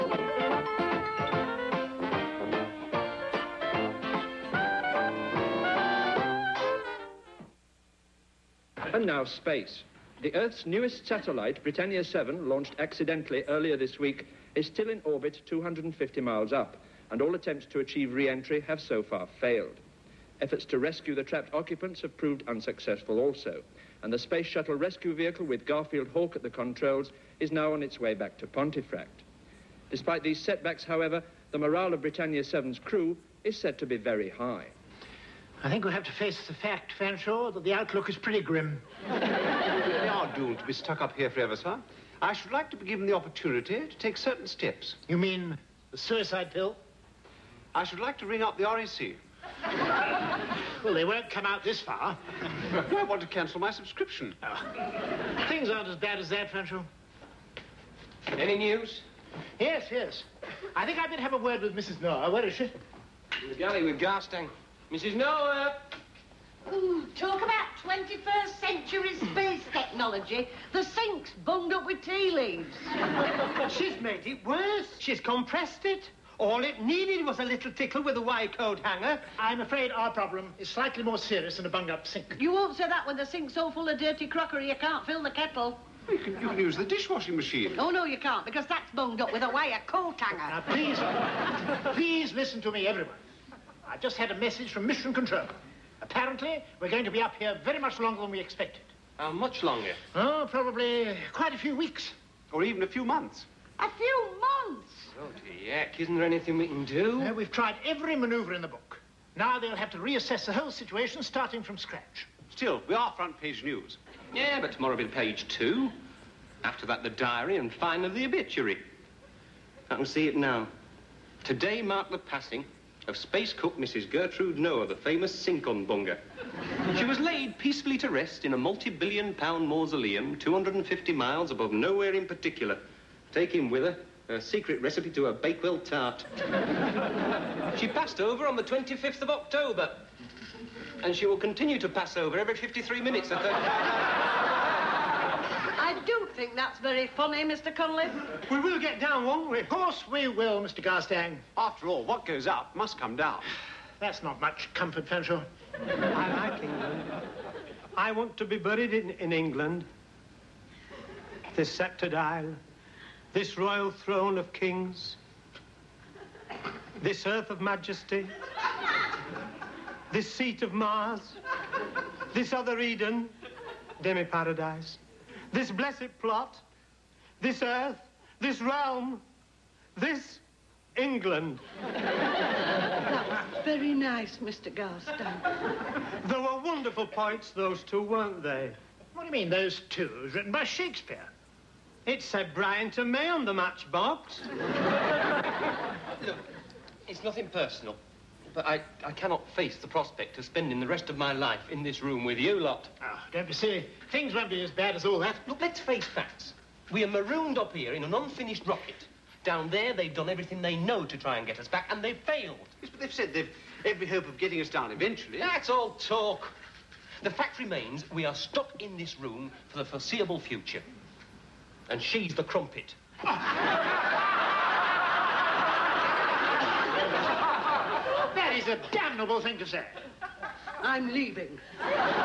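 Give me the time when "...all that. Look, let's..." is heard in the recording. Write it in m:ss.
3:25.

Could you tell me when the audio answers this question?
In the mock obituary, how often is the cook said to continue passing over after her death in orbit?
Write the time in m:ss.
2:22.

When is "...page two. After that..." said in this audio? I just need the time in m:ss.
1:55.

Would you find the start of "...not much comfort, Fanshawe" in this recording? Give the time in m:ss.
2:34.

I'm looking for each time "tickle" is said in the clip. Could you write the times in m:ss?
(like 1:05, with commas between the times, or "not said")
1:17.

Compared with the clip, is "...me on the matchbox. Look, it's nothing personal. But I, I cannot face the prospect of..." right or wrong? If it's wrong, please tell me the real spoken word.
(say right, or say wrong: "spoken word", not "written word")
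right.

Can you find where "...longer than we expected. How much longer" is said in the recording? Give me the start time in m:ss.
1:37.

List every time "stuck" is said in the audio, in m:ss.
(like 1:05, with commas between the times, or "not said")
0:40, 3:38.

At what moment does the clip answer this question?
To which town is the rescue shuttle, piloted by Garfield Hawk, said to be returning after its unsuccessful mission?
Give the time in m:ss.
0:28.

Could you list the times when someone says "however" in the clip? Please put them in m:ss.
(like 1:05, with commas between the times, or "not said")
0:30.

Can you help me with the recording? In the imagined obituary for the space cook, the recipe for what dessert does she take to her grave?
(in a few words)
Bakewell tart.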